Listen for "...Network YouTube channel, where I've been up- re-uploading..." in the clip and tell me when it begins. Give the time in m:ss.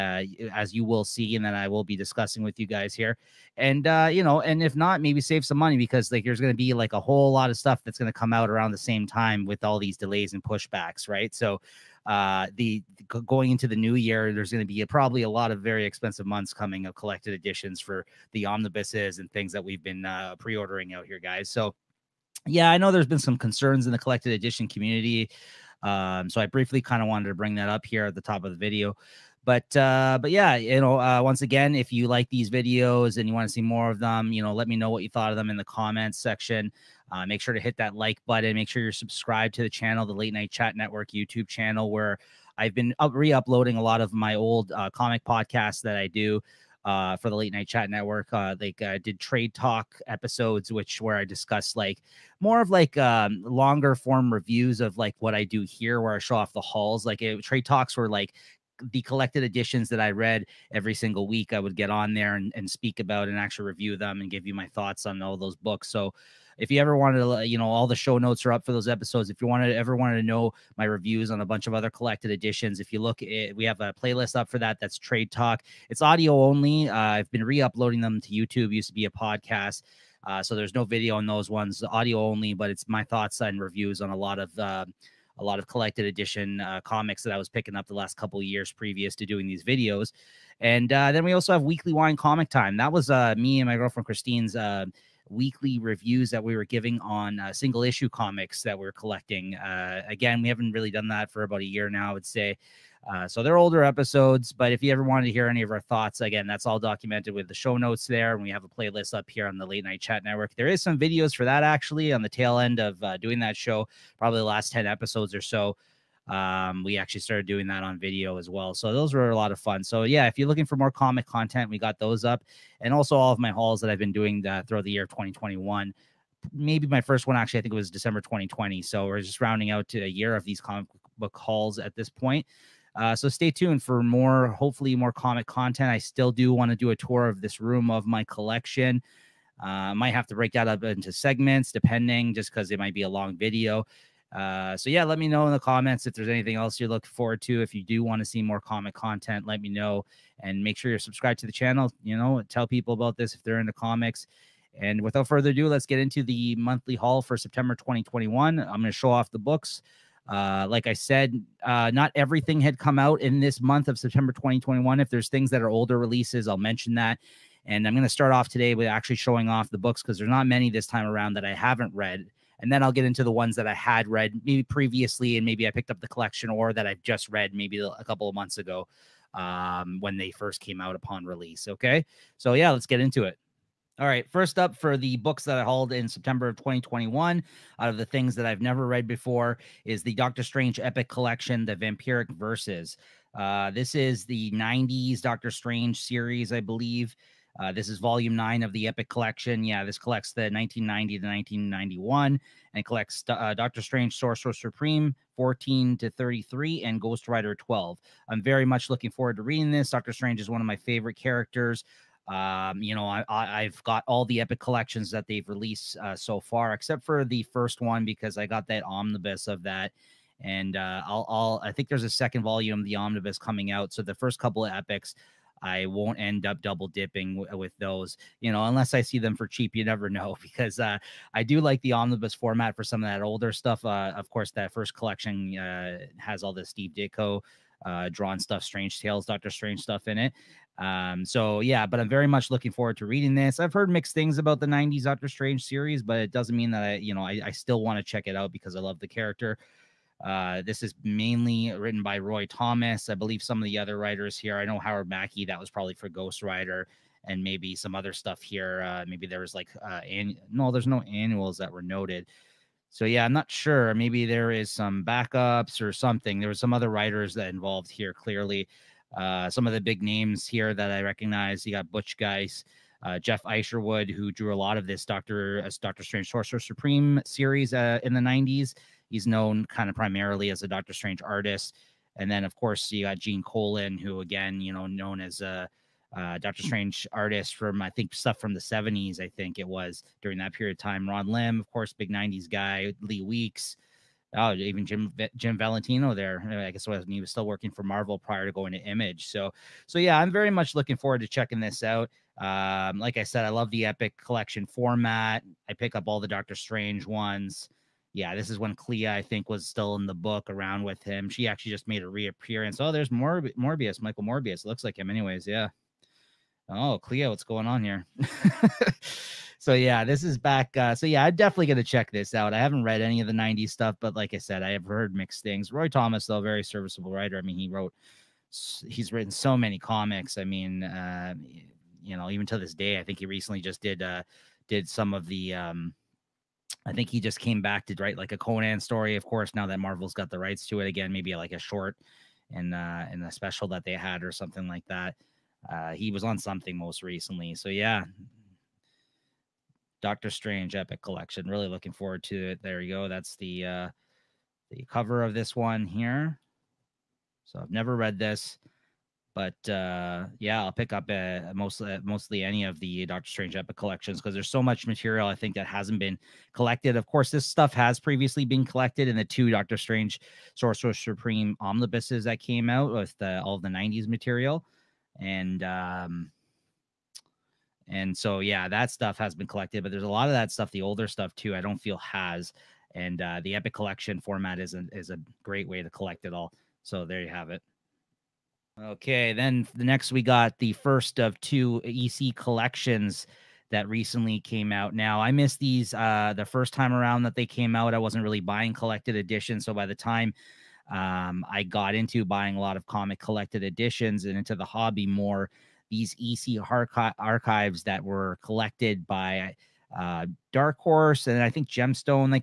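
0:40.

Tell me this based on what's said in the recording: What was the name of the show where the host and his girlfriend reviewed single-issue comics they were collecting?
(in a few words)
Weekly Wine Comic Time.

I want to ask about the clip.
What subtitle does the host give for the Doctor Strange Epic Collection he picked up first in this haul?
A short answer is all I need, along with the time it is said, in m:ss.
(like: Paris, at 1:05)
The Vampiric Verses, at 3:11.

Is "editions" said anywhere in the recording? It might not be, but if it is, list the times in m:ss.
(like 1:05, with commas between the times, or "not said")
0:17, 0:24, 0:59, 1:12, 1:26, 6:39, 6:43.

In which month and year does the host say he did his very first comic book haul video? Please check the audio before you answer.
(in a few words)
December 2020.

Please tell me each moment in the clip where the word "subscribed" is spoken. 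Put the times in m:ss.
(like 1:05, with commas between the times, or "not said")
0:38, 2:30.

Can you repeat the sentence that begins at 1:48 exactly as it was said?
And we have a playlist up here on the Late Night Chat Network.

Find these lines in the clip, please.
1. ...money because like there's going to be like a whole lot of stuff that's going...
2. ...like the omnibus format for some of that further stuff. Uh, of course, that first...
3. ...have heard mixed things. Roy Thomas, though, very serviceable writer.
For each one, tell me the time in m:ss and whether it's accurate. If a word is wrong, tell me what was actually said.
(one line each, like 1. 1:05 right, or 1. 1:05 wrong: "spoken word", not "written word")
1. 0:05 right
2. 3:51 wrong: "older", not "further"
3. 5:24 right.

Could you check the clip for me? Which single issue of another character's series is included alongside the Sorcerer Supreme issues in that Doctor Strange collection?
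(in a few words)
Ghost Rider 12.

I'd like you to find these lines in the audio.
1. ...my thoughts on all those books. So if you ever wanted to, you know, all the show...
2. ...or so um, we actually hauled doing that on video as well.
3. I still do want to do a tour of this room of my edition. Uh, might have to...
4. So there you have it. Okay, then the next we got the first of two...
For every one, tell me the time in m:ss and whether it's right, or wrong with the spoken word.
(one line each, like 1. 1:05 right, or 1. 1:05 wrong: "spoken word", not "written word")
1. 1:04 right
2. 1:55 wrong: "started", not "hauled"
3. 2:15 wrong: "collection", not "edition"
4. 6:26 right.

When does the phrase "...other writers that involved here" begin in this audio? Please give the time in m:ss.
4:26.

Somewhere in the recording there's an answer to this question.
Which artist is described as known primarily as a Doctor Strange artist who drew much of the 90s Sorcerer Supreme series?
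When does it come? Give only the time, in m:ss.
4:33.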